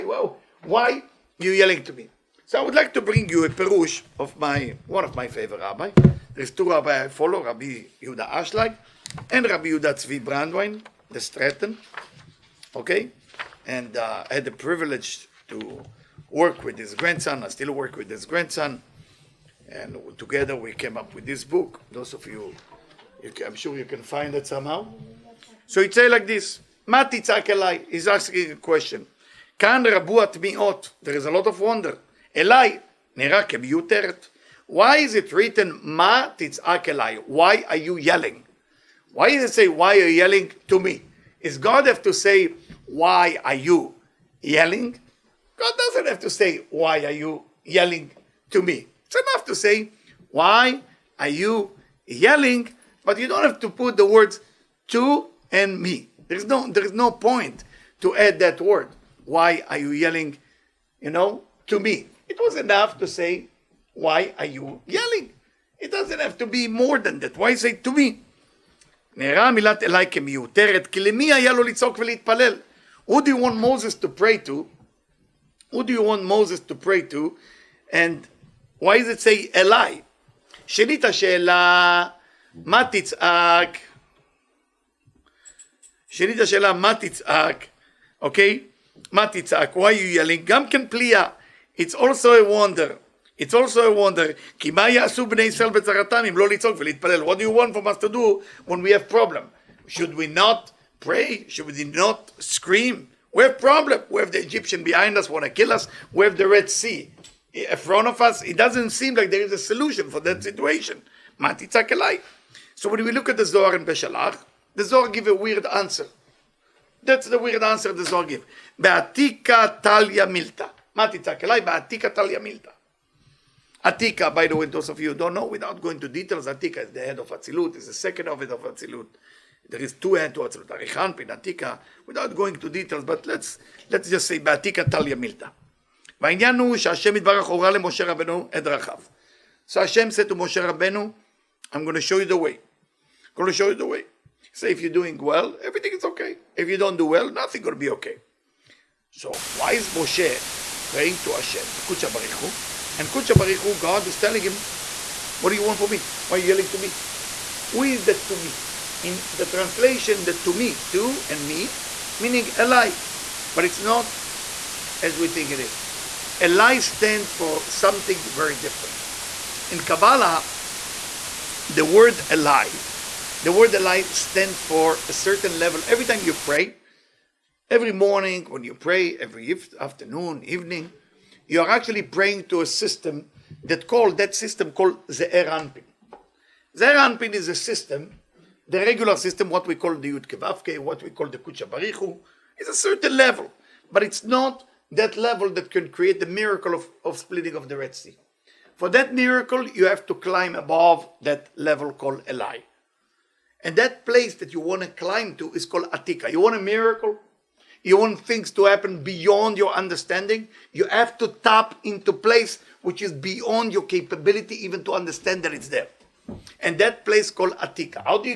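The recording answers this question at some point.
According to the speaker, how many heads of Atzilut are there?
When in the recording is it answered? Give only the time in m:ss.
2:09.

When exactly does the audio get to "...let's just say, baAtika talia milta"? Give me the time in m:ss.
2:13.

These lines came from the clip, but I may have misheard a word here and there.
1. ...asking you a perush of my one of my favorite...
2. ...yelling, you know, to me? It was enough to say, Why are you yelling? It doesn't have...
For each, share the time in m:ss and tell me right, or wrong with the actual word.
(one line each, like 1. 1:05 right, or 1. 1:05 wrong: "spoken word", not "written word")
1. 0:03 wrong: "bring", not "asking"
2. 0:59 right.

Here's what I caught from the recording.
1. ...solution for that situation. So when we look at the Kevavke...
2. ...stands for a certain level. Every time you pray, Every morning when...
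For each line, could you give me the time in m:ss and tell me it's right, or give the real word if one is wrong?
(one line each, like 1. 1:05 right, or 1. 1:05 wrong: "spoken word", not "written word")
1. 1:49 wrong: "Zohar", not "Kevavke"
2. 2:54 right.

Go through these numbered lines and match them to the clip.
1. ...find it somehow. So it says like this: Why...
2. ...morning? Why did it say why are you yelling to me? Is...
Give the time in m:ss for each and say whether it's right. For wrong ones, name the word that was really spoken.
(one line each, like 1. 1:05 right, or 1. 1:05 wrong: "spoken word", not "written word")
1. 0:24 wrong: "Mati", not "Why"
2. 0:37 wrong: "yelling", not "morning".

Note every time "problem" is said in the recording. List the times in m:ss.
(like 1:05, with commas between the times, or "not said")
1:39, 1:43.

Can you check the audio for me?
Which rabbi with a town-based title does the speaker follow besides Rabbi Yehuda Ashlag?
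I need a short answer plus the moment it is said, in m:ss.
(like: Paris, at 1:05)
Rabbi Yuda Tzvi Brandwein, at 0:09.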